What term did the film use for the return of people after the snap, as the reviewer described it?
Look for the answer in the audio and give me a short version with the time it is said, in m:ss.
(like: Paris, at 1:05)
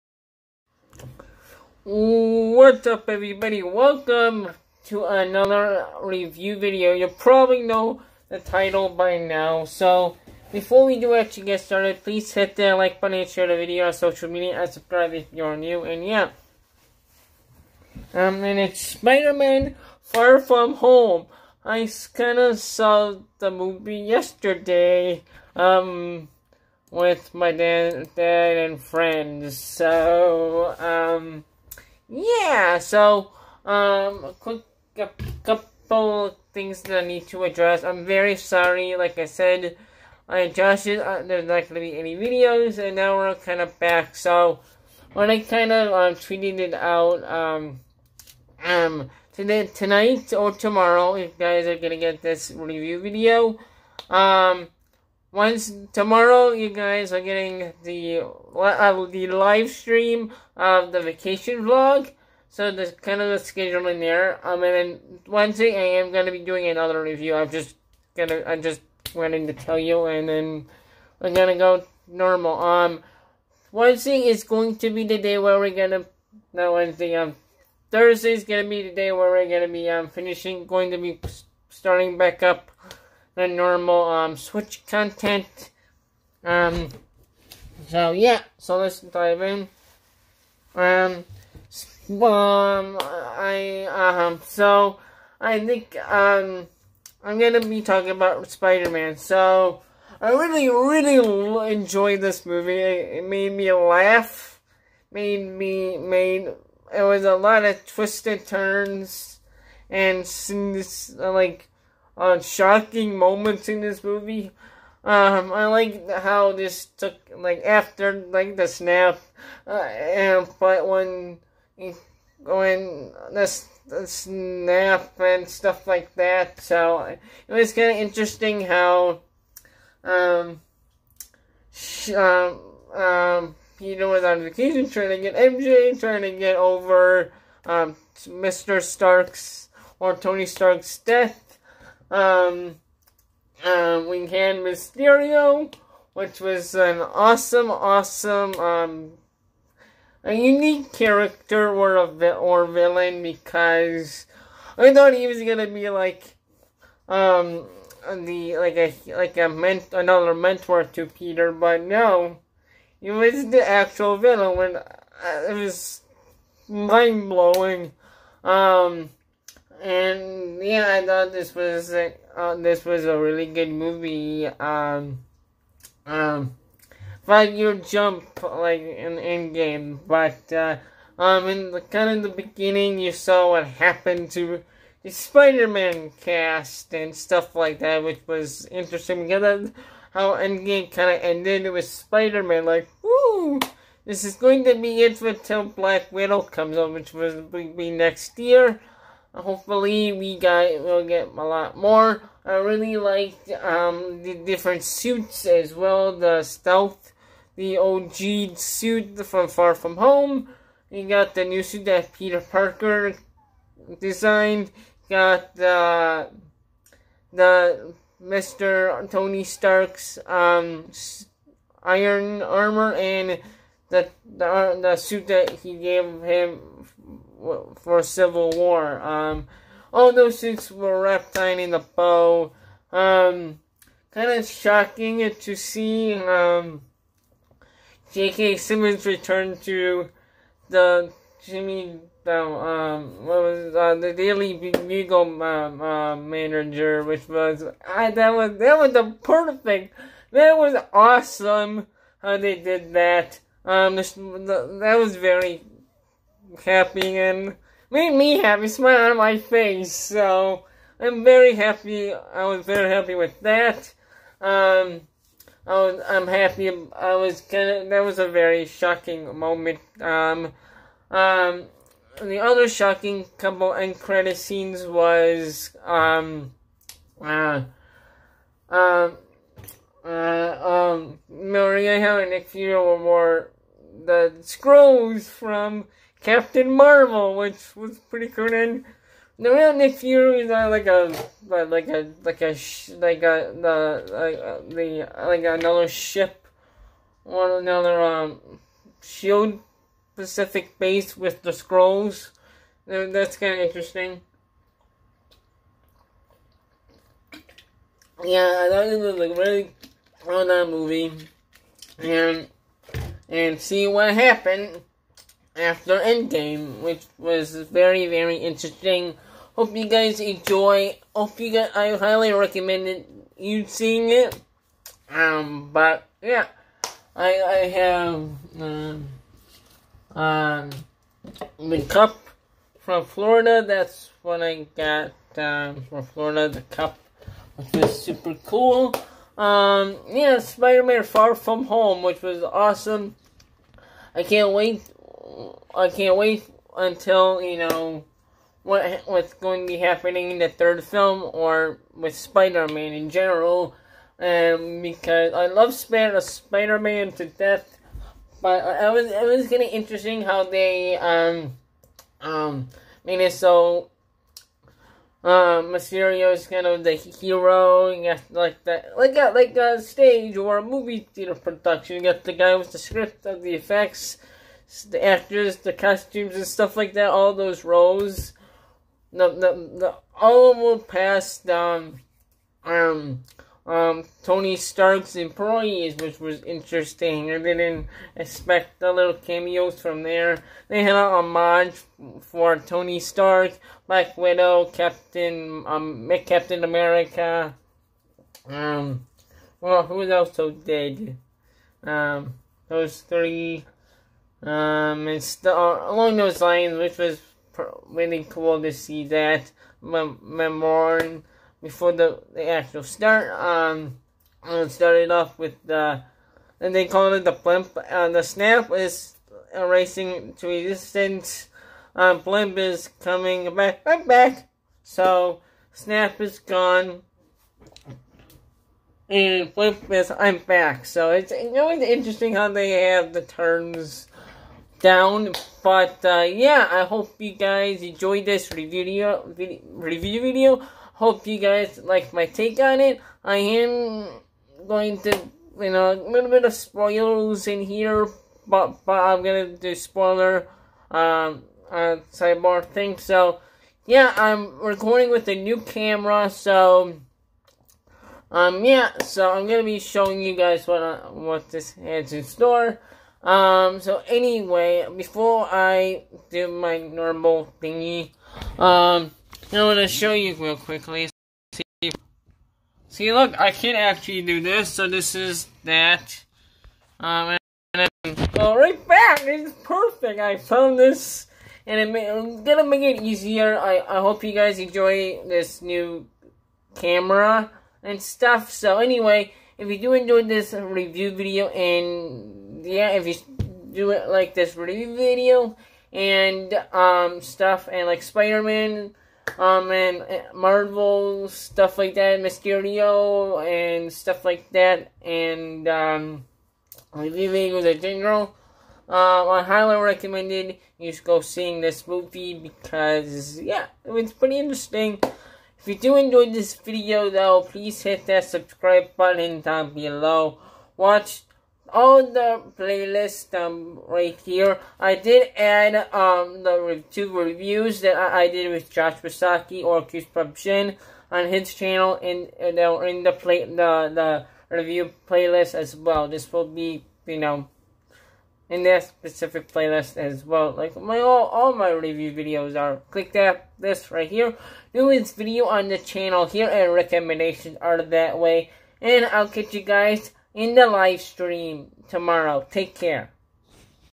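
The blimp, at 6:57.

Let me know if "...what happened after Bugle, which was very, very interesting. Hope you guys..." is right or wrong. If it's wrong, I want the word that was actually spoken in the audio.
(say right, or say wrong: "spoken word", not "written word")
wrong: "Endgame", not "Bugle".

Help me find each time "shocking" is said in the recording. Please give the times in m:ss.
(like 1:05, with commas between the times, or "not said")
1:52, 3:54, 4:28, 4:32.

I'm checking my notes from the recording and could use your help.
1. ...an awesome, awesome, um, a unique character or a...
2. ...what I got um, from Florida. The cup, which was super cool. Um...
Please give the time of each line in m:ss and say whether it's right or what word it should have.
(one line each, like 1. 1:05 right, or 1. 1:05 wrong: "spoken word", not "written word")
1. 2:26 right
2. 5:34 right.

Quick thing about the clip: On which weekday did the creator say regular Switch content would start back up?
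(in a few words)
Thursday.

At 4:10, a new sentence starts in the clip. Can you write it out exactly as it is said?
That was awesome how they did that.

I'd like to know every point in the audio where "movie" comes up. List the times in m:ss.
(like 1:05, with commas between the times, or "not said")
0:23, 1:42, 1:54, 2:53, 5:10, 6:10, 8:31.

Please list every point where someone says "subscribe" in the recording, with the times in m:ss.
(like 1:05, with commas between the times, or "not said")
0:14, 8:38.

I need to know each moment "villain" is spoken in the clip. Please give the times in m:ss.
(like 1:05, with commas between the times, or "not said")
2:32, 2:44.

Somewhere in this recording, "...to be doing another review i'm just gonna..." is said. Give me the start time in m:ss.
1:06.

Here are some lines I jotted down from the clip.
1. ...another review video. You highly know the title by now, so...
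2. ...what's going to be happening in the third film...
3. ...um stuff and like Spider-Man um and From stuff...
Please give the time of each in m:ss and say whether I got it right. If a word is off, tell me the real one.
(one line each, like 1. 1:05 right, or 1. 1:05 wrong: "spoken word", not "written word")
1. 0:05 wrong: "probably", not "highly"
2. 5:49 right
3. 8:16 wrong: "Marvel", not "From".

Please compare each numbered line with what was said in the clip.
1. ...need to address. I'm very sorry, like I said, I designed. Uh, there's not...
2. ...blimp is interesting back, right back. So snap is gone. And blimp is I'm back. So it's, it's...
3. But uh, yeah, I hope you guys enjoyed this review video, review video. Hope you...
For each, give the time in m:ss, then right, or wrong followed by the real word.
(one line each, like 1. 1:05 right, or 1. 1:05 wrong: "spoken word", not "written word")
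1. 0:37 wrong: "adjusted", not "designed"
2. 7:02 wrong: "coming", not "interesting"
3. 7:15 right.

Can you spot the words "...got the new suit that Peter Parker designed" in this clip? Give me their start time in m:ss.
3:31.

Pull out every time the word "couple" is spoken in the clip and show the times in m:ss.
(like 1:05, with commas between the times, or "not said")
0:35, 4:33.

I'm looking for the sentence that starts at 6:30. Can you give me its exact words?
They had a homage for Tony Stark, Black Widow, Captain, um, Captain America.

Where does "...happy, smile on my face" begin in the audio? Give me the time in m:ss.
4:18.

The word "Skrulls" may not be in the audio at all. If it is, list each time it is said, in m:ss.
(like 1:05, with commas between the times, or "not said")
4:44, 5:01.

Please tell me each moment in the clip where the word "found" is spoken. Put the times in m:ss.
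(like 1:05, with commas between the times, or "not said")
8:00.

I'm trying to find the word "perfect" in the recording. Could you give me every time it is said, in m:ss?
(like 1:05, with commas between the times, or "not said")
4:09, 7:59.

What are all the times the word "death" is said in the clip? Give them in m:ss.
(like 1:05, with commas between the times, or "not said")
2:20, 5:57.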